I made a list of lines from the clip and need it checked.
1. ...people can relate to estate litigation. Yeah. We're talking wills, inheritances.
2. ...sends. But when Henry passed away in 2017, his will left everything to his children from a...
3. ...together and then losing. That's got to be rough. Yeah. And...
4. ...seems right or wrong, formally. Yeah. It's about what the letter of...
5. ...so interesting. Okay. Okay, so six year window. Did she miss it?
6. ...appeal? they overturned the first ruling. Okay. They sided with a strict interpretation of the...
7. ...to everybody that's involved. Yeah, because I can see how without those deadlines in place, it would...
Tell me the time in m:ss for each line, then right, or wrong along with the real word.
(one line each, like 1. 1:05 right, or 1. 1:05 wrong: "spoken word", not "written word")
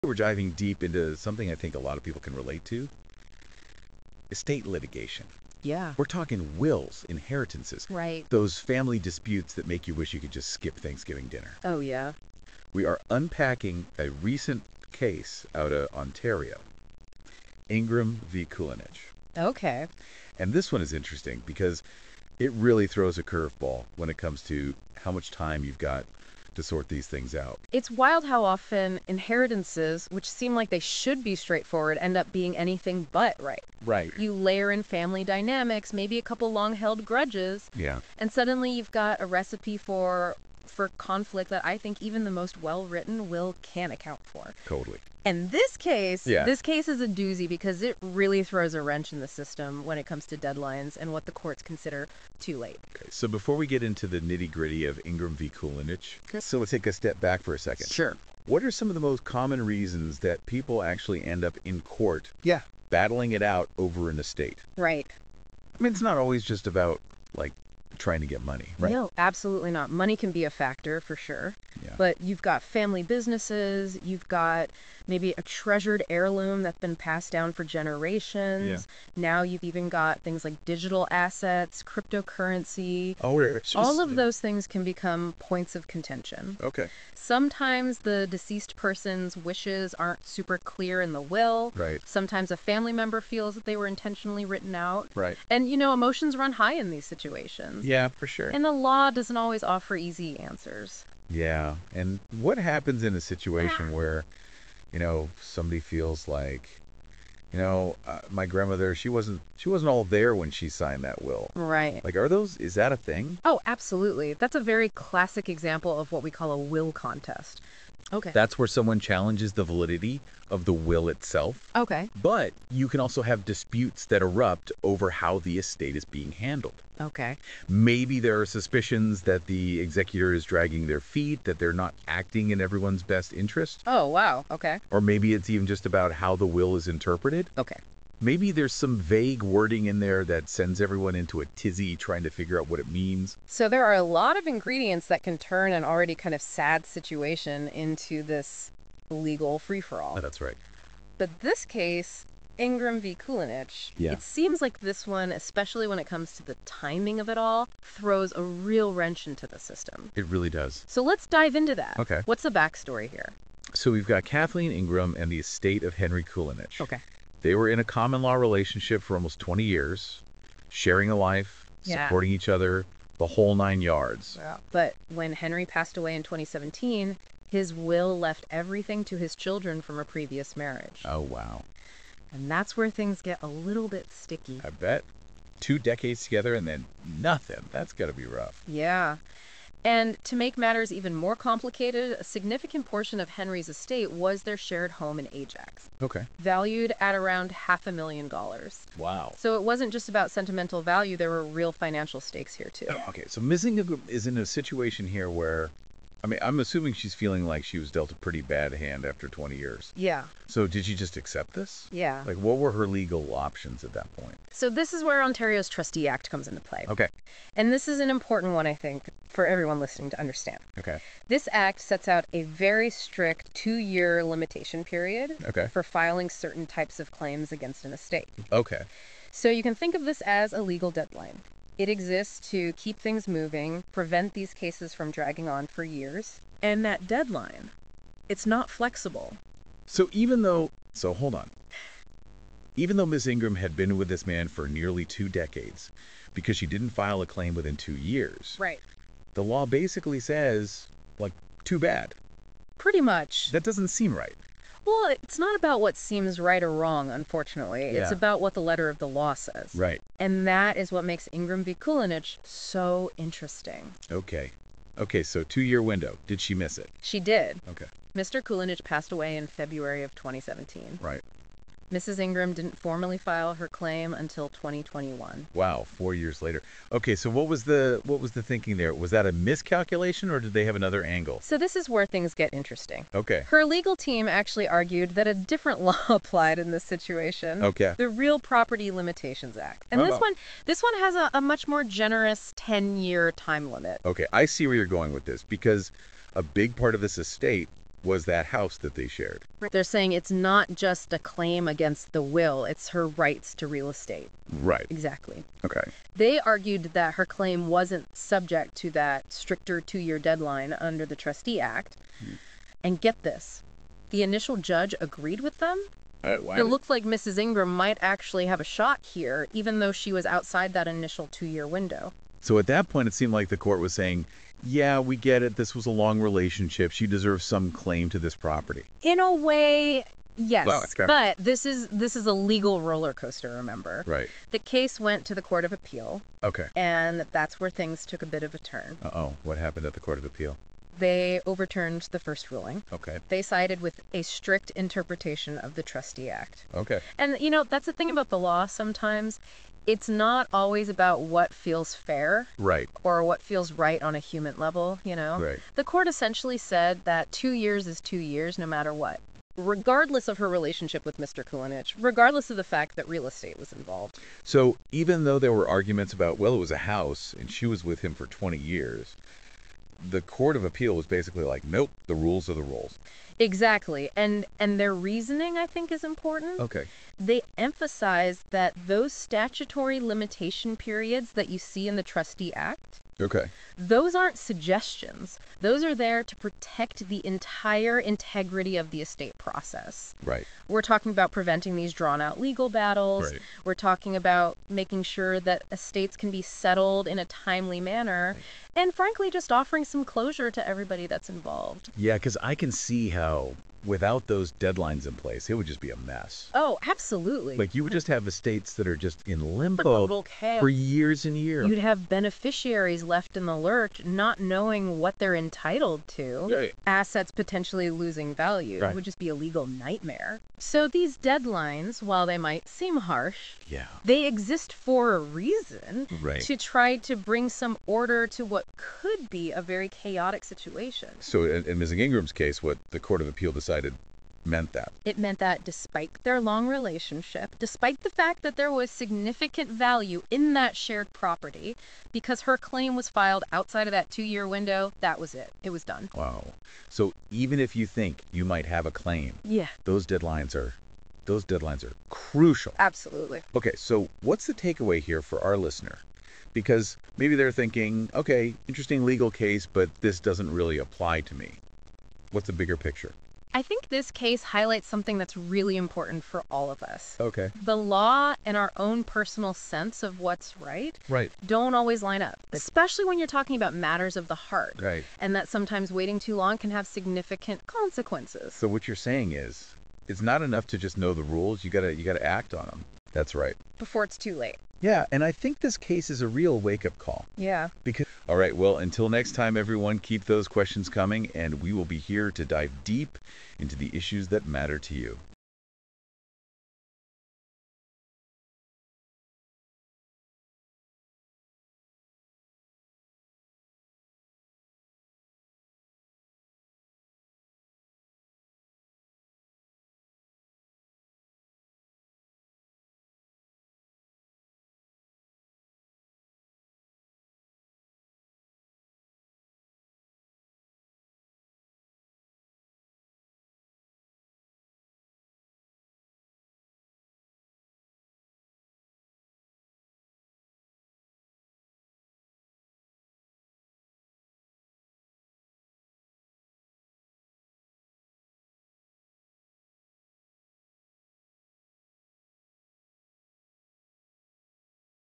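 1. 0:02 right
2. 2:53 wrong: "yards", not "sends"
3. 3:06 wrong: "nothing", not "losing"
4. 4:15 wrong: "unfortunately", not "formally"
5. 4:22 wrong: "two", not "six"
6. 5:40 right
7. 6:40 right.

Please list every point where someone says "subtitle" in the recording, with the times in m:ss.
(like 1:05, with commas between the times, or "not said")
not said.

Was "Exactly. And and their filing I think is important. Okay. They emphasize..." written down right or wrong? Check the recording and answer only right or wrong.
wrong.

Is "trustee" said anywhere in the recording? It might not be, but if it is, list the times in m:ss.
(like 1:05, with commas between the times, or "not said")
3:35, 5:11, 5:45, 6:22.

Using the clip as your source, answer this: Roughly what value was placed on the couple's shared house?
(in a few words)
half a million dollars.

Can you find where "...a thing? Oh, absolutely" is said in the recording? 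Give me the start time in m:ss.
1:52.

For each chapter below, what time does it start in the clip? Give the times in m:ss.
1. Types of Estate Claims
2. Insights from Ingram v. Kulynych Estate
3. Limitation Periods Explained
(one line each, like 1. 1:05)
1. 1:45
2. 6:30
3. 4:10.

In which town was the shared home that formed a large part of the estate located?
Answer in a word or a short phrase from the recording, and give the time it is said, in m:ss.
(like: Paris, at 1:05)
Ajax, at 3:15.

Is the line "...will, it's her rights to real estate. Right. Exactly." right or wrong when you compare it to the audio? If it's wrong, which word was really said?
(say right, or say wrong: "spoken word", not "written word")
right.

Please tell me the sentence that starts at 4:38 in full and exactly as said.
Was that a miscalculation, or did they have another angle?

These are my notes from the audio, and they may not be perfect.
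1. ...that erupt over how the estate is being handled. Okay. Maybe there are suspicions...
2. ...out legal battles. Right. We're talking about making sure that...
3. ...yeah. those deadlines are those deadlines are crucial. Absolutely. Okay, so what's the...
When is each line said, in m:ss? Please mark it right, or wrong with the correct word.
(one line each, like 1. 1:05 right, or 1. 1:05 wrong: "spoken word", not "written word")
1. 2:04 right
2. 6:32 right
3. 7:29 right.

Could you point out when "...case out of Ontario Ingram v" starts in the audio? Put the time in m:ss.
0:14.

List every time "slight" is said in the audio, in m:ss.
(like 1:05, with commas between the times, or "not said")
not said.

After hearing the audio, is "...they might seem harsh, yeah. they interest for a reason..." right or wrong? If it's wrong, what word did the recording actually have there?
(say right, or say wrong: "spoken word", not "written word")
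wrong: "exist", not "interest".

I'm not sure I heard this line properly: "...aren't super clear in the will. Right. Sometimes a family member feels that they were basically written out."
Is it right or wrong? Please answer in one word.
wrong.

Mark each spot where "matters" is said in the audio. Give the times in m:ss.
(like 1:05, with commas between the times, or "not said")
3:10, 5:58, 7:53, 8:14.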